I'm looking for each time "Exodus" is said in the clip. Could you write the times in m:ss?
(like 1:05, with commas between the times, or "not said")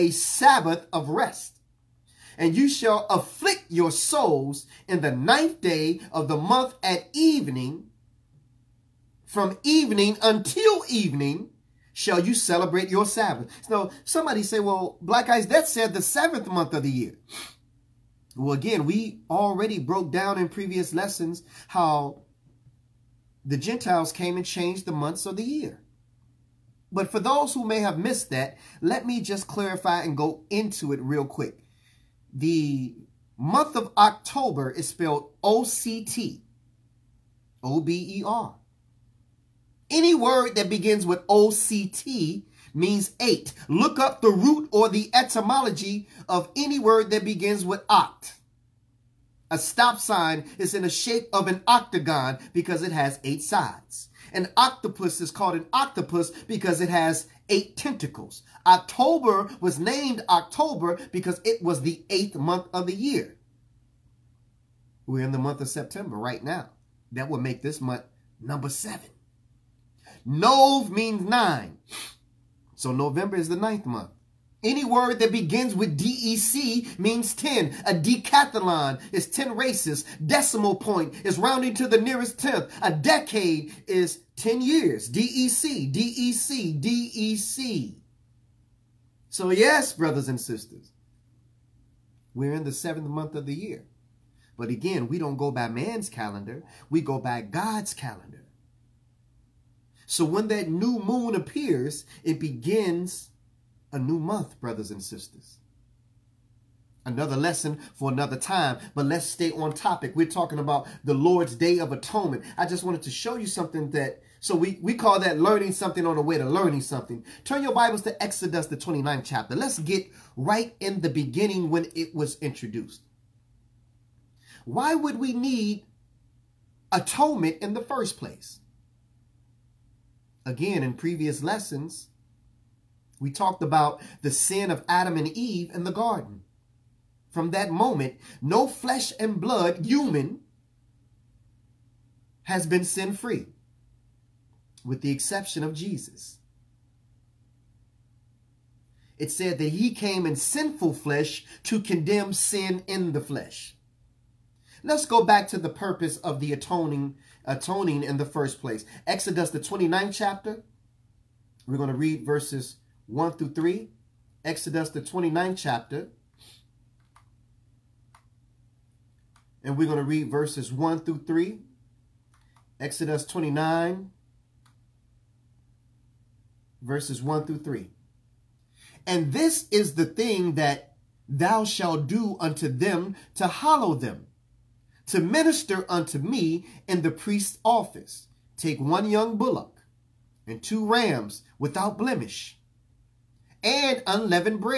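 1:58, 2:39, 2:44, 2:52.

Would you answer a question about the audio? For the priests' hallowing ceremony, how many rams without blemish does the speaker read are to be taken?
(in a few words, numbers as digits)
2.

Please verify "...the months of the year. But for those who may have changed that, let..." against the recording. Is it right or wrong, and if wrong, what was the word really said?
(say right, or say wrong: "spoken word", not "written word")
wrong: "missed", not "changed".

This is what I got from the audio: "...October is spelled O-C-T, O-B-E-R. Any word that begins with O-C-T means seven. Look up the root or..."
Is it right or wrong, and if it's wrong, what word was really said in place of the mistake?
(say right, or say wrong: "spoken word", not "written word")
wrong: "eight", not "seven".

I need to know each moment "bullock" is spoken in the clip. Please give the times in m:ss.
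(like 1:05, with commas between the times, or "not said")
3:09.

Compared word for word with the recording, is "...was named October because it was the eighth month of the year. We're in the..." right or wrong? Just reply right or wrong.
right.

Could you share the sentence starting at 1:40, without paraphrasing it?
So when that new moon appears, it begins a new month, brothers and sisters.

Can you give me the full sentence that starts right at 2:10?
Again, in previous lessons, we talked about the sin of Adam and Eve in the garden.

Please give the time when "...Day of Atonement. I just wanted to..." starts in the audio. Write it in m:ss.
1:51.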